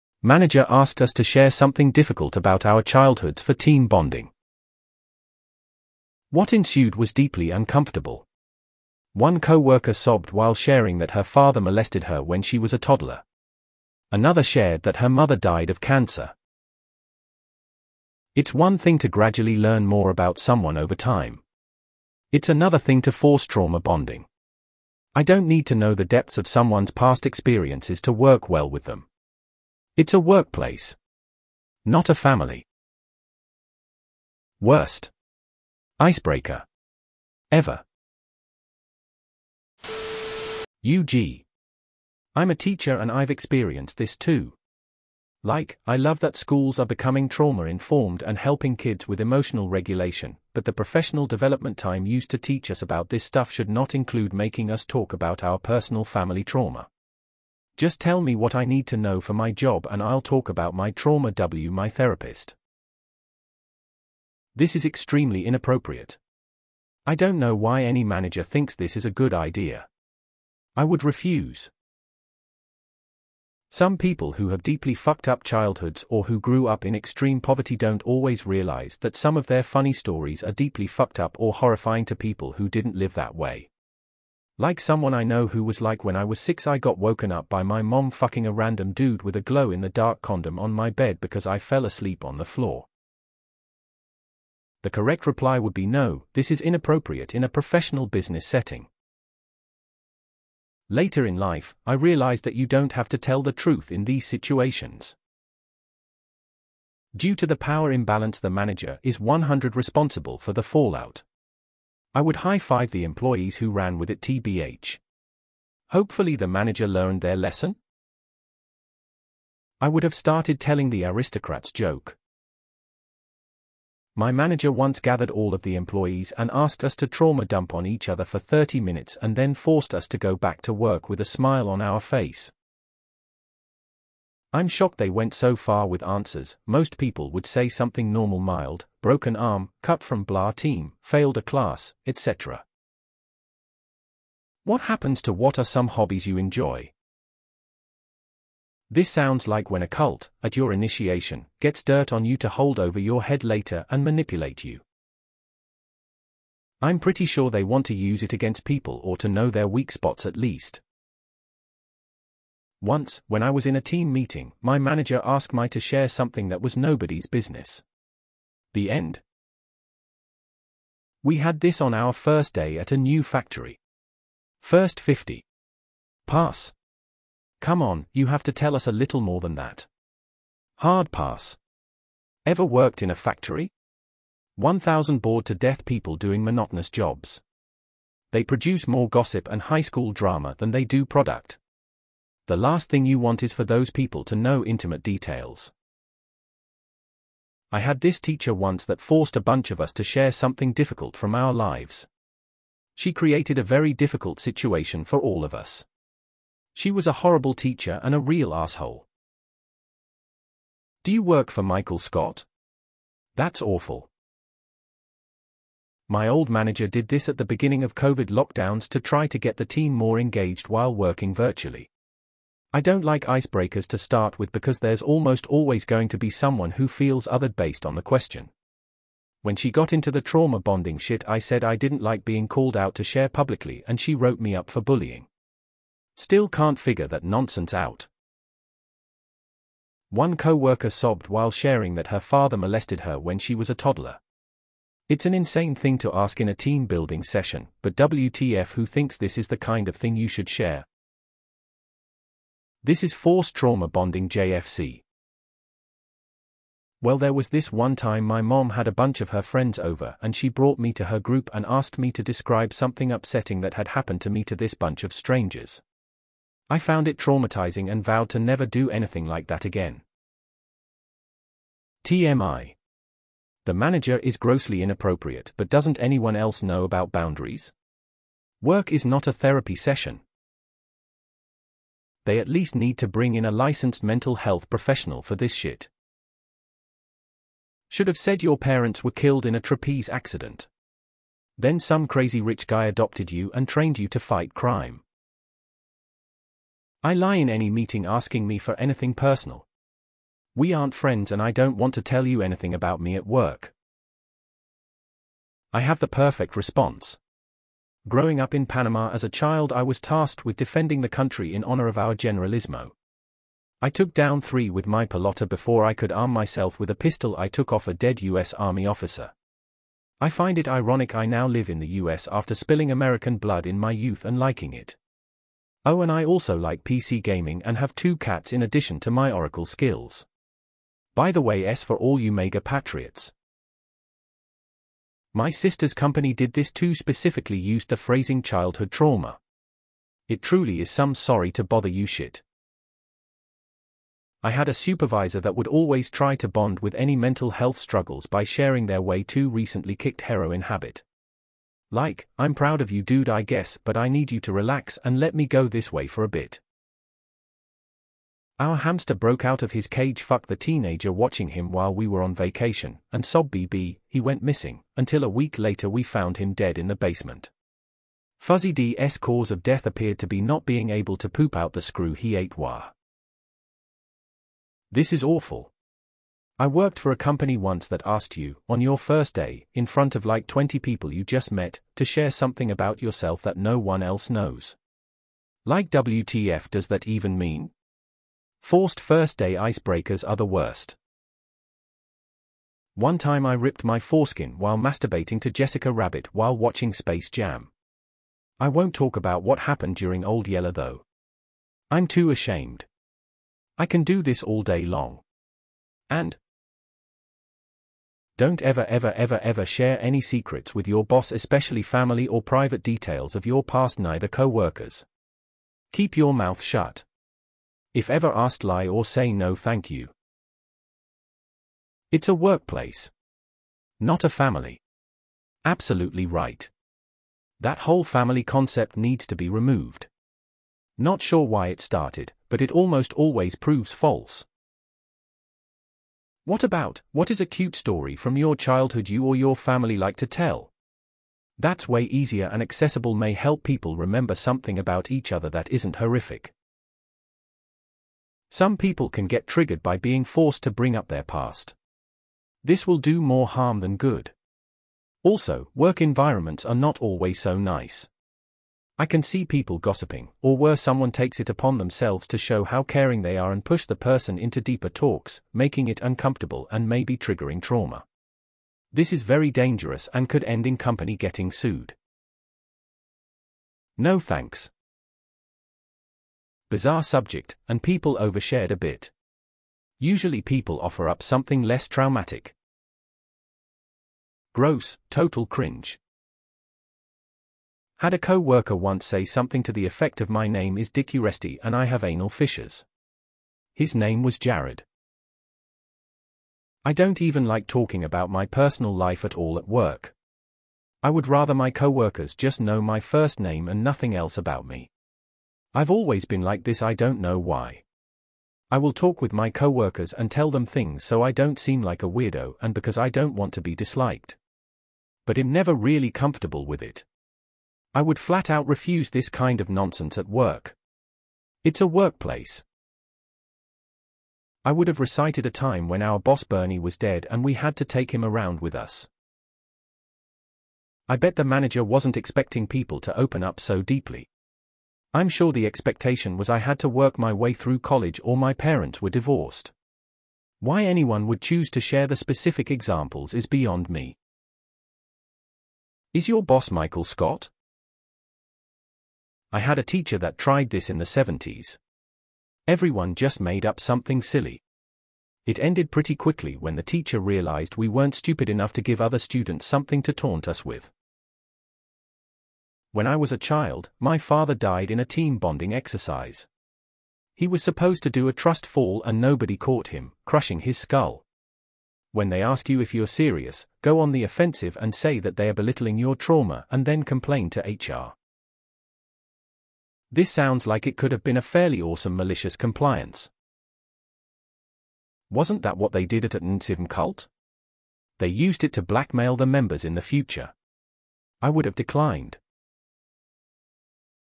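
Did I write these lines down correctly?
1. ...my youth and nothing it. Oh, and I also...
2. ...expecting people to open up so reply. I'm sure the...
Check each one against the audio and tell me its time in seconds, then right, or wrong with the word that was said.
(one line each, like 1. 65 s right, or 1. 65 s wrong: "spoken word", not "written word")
1. 323 s wrong: "liking", not "nothing"
2. 532 s wrong: "deeply", not "reply".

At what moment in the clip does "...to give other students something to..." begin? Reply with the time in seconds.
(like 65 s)
558 s.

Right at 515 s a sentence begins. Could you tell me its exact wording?
But I'm never really comfortable with it.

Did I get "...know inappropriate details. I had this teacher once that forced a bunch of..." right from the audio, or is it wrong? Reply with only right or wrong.
wrong.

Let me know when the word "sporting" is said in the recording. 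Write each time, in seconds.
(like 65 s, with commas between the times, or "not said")
not said.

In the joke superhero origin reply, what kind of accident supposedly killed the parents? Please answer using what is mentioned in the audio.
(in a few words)
Trapeze accident.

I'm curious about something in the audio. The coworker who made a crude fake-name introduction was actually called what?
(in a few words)
Jared.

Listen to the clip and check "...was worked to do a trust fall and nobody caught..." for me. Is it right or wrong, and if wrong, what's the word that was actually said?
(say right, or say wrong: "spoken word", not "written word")
wrong: "supposed", not "worked".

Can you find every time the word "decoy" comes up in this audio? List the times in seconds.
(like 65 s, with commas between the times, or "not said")
not said.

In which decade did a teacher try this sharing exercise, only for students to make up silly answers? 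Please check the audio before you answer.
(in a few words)
The 1970s.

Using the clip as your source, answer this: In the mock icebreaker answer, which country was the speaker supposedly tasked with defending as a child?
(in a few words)
Panama.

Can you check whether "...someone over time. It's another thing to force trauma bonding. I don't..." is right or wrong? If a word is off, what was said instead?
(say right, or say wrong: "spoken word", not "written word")
right.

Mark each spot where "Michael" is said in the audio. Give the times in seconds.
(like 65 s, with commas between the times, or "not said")
211 s, 546 s.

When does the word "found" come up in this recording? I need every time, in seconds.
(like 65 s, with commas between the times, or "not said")
266 s, 366 s.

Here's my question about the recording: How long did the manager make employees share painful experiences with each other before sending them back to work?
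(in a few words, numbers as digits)
30 minutes.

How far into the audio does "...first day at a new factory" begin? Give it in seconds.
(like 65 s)
172 s.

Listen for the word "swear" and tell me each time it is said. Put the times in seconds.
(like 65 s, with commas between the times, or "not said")
not said.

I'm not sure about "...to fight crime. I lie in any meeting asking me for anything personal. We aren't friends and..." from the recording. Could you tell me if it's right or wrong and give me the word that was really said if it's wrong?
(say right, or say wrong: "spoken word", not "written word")
right.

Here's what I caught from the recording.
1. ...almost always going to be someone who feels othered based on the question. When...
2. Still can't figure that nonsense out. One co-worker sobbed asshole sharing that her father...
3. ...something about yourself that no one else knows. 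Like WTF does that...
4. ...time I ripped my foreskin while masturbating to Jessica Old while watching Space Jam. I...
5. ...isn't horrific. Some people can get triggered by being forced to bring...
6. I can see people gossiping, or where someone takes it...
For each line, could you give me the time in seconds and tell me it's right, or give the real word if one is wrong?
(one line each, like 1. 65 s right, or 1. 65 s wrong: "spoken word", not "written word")
1. 225 s right
2. 236 s wrong: "while", not "asshole"
3. 382 s right
4. 393 s wrong: "Rabbit", not "Old"
5. 445 s right
6. 458 s right.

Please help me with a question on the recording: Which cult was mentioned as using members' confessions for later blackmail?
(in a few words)
NXIVM.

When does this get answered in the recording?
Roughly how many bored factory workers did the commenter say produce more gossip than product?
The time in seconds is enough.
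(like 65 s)
184 s.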